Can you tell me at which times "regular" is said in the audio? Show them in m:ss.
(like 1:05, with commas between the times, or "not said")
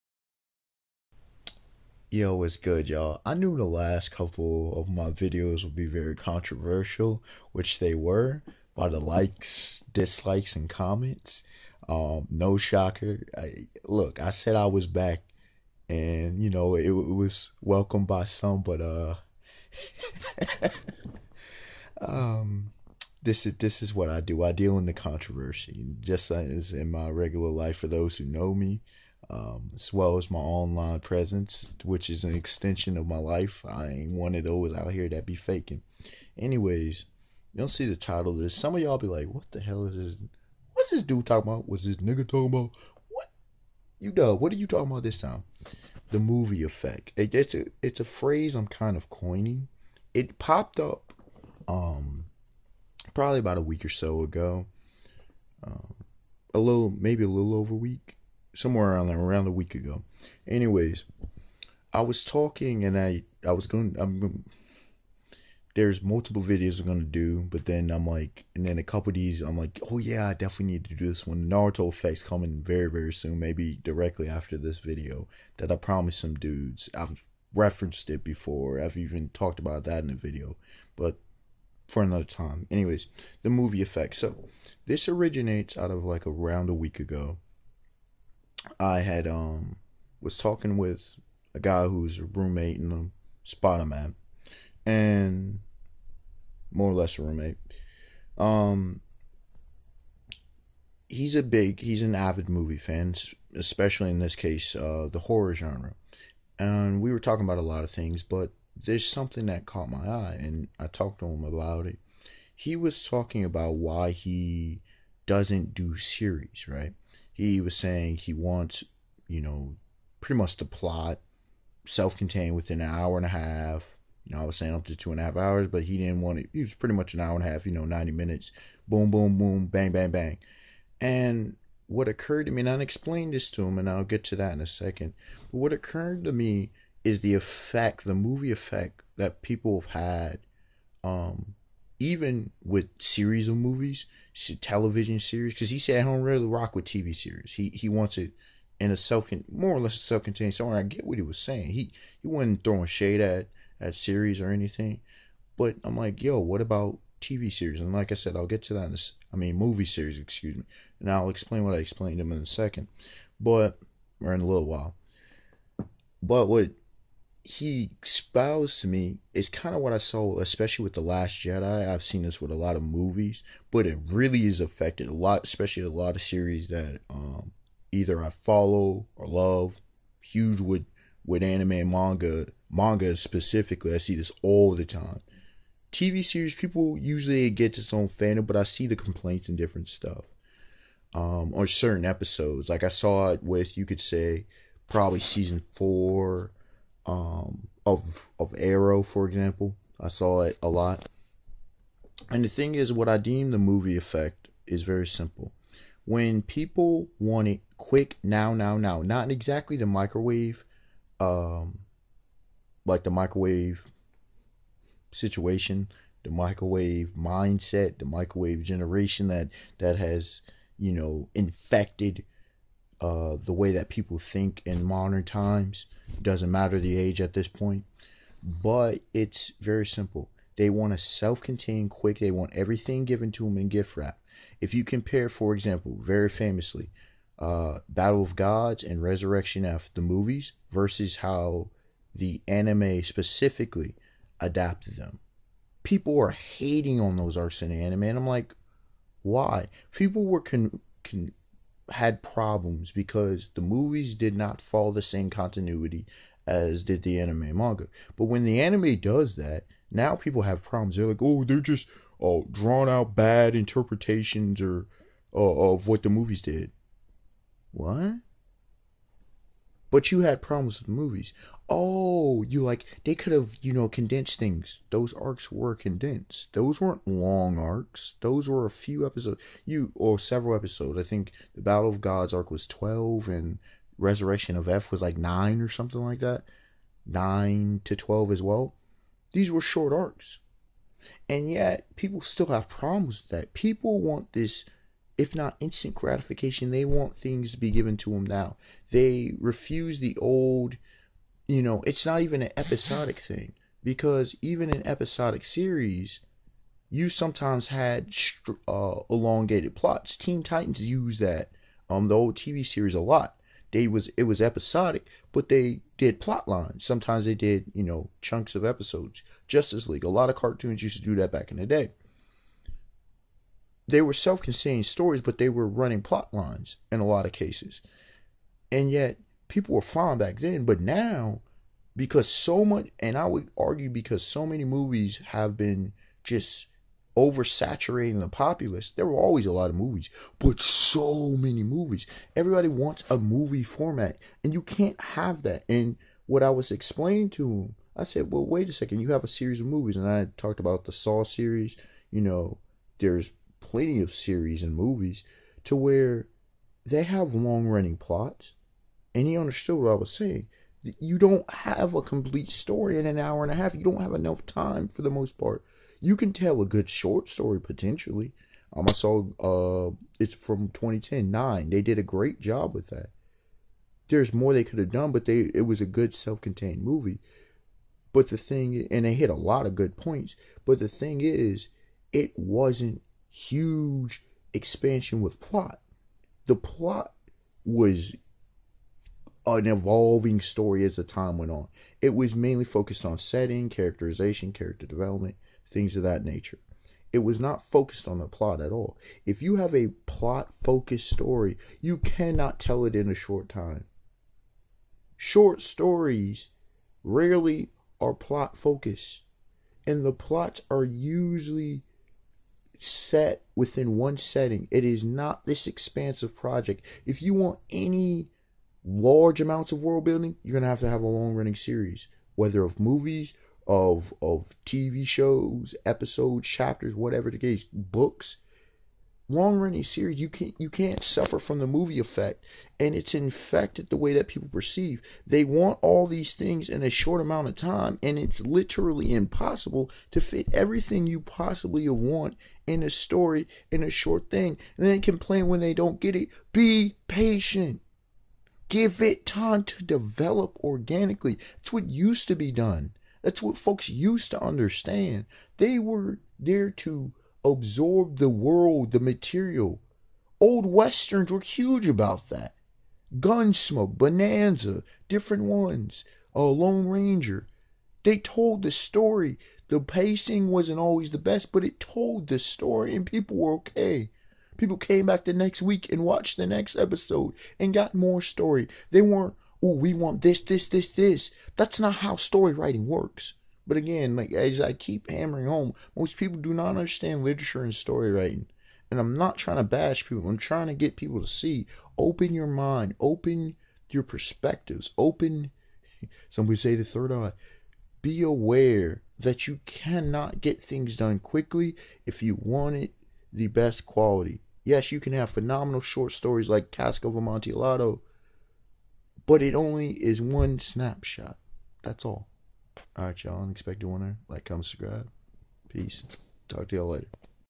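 0:27.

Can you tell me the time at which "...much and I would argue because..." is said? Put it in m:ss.
5:32.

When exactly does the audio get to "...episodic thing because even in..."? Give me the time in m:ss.
5:02.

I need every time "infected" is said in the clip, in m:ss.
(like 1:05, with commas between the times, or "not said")
3:41, 7:13.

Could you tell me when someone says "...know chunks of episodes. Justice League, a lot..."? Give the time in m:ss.
5:17.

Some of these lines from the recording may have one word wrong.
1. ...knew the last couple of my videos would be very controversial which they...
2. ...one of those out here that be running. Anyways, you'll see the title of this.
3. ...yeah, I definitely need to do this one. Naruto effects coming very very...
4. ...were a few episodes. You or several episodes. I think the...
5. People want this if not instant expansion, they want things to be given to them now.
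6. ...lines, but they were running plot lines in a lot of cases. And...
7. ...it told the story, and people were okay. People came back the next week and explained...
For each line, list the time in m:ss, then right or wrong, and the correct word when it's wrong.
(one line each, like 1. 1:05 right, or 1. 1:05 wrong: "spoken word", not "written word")
1. 0:03 right
2. 0:34 wrong: "faking", not "running"
3. 1:09 right
4. 4:38 right
5. 4:53 wrong: "gratification", not "expansion"
6. 5:24 wrong: "stories", not "lines"
7. 7:51 wrong: "watched", not "explained".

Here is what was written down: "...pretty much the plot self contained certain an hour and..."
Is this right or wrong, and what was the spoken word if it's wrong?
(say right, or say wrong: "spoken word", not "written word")
wrong: "within", not "certain".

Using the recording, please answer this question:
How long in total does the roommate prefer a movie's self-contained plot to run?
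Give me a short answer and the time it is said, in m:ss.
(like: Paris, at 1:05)
90 minutes, at 2:07.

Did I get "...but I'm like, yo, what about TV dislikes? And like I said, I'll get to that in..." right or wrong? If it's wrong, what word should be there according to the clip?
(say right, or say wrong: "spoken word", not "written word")
wrong: "series", not "dislikes".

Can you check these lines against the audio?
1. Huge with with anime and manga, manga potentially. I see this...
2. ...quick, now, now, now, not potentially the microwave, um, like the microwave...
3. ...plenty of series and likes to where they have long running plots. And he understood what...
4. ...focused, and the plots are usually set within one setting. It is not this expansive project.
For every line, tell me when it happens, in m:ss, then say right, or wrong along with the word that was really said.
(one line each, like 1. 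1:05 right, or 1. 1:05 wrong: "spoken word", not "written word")
1. 3:00 wrong: "specifically", not "potentially"
2. 3:27 wrong: "exactly", not "potentially"
3. 5:53 wrong: "movies", not "likes"
4. 6:48 right.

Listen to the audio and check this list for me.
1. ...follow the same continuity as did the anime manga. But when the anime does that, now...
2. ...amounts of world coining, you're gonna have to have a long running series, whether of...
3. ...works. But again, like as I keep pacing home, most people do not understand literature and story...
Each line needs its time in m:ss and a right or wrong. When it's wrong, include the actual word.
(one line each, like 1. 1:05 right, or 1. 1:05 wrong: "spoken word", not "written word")
1. 4:14 right
2. 6:59 wrong: "building", not "coining"
3. 8:02 wrong: "hammering", not "pacing".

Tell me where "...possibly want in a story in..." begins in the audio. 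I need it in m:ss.
7:21.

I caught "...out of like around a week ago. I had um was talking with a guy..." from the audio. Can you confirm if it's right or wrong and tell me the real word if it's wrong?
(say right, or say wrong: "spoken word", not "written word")
right.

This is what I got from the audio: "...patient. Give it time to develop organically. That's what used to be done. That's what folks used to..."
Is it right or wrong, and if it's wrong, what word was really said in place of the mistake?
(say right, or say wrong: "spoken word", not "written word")
right.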